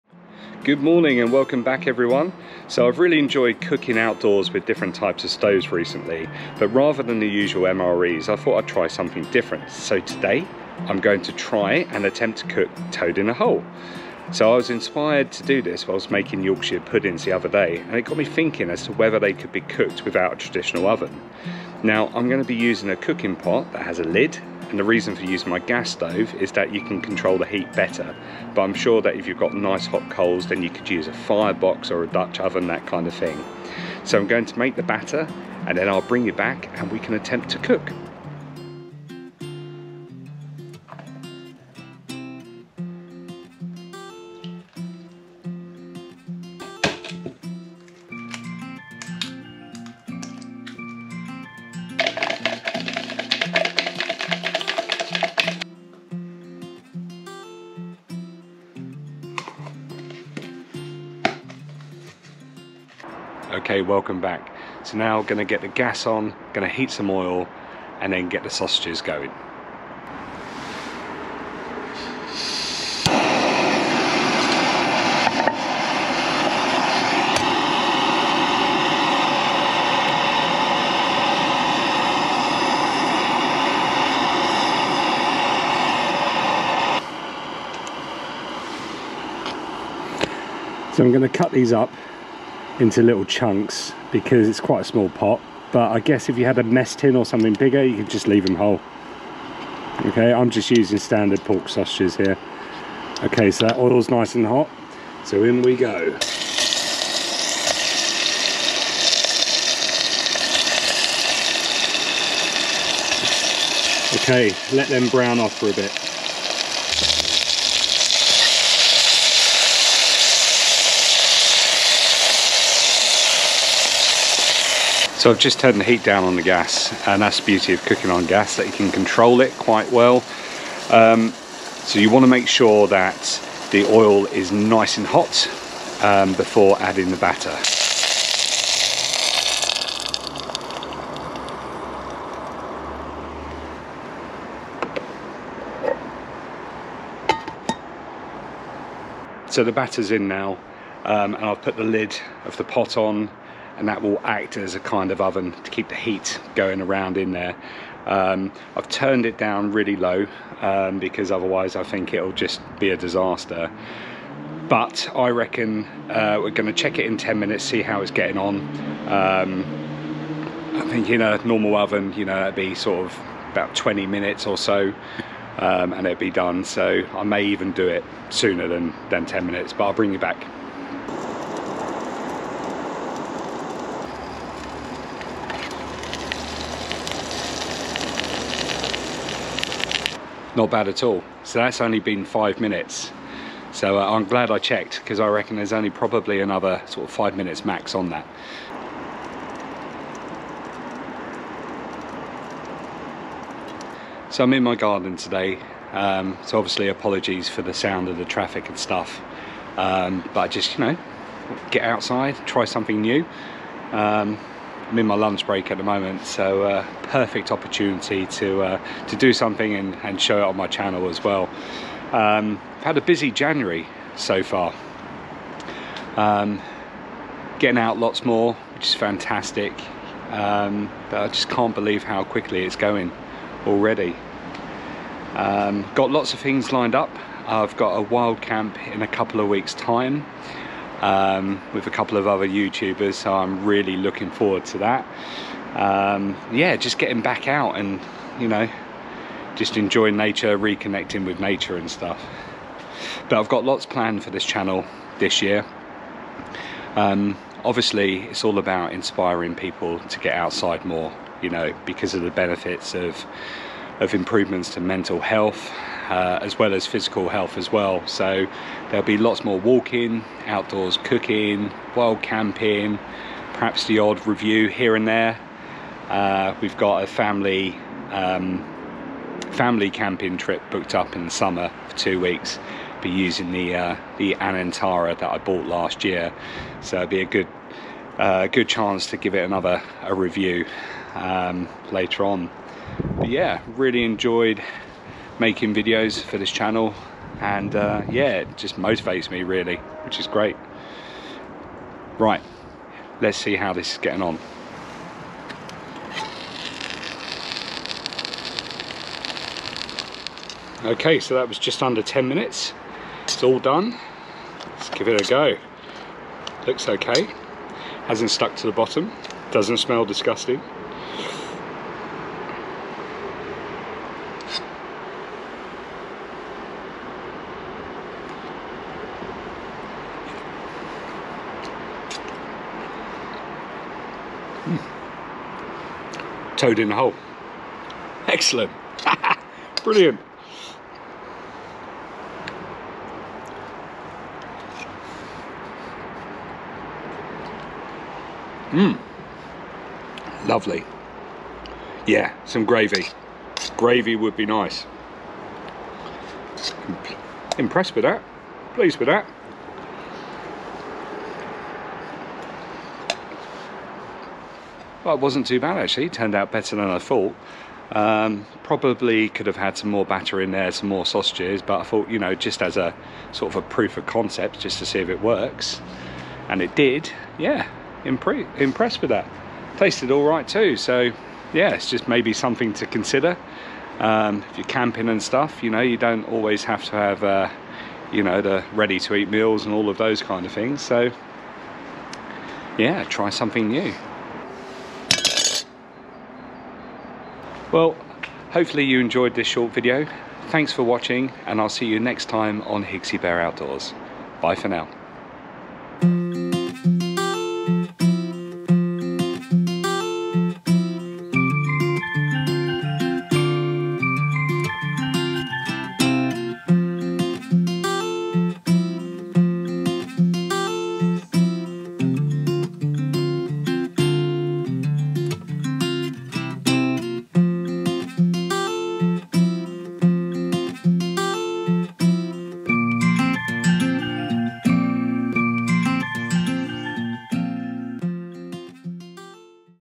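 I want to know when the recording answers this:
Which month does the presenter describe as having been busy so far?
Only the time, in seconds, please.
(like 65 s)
223 s.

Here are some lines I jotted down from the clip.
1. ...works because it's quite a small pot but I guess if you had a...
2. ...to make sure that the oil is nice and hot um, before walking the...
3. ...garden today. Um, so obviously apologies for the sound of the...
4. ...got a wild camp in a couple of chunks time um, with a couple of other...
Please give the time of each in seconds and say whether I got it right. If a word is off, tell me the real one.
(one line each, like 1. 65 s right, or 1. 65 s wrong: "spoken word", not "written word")
1. 93 s wrong: "chunks", not "works"
2. 132 s wrong: "adding", not "walking"
3. 204 s right
4. 237 s wrong: "weeks", not "chunks".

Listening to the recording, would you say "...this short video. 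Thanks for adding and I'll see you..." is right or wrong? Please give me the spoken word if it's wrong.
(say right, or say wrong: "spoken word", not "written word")
wrong: "watching", not "adding".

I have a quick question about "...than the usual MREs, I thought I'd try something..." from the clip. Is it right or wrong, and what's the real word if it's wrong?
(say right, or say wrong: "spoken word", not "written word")
right.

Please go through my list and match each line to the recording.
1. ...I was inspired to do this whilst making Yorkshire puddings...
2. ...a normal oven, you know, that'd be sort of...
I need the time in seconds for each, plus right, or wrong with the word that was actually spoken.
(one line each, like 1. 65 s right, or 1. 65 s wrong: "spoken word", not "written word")
1. 14 s right
2. 171 s right.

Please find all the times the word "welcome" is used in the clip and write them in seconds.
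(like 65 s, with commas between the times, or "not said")
1 s, 63 s.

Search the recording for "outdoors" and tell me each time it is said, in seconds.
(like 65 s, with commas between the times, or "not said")
3 s, 270 s, 403 s.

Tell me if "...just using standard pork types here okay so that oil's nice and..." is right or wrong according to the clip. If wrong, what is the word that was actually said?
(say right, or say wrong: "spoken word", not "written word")
wrong: "sausages", not "types".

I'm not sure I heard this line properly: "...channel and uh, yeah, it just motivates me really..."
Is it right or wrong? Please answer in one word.
right.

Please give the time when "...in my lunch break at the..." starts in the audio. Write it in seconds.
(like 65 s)
214 s.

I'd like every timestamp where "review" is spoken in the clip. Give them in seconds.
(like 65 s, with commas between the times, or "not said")
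274 s, 290 s.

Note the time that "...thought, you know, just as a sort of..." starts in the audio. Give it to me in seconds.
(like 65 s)
371 s.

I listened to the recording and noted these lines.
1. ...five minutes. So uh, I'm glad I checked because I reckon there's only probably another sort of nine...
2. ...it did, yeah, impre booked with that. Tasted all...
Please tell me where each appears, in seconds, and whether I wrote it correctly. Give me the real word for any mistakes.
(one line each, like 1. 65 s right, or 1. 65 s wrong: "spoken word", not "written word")
1. 192 s wrong: "five", not "nine"
2. 376 s wrong: "impressed", not "booked".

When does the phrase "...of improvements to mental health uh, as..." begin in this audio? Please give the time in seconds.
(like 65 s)
264 s.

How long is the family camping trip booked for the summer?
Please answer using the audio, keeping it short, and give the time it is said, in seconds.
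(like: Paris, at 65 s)
Two weeks, at 281 s.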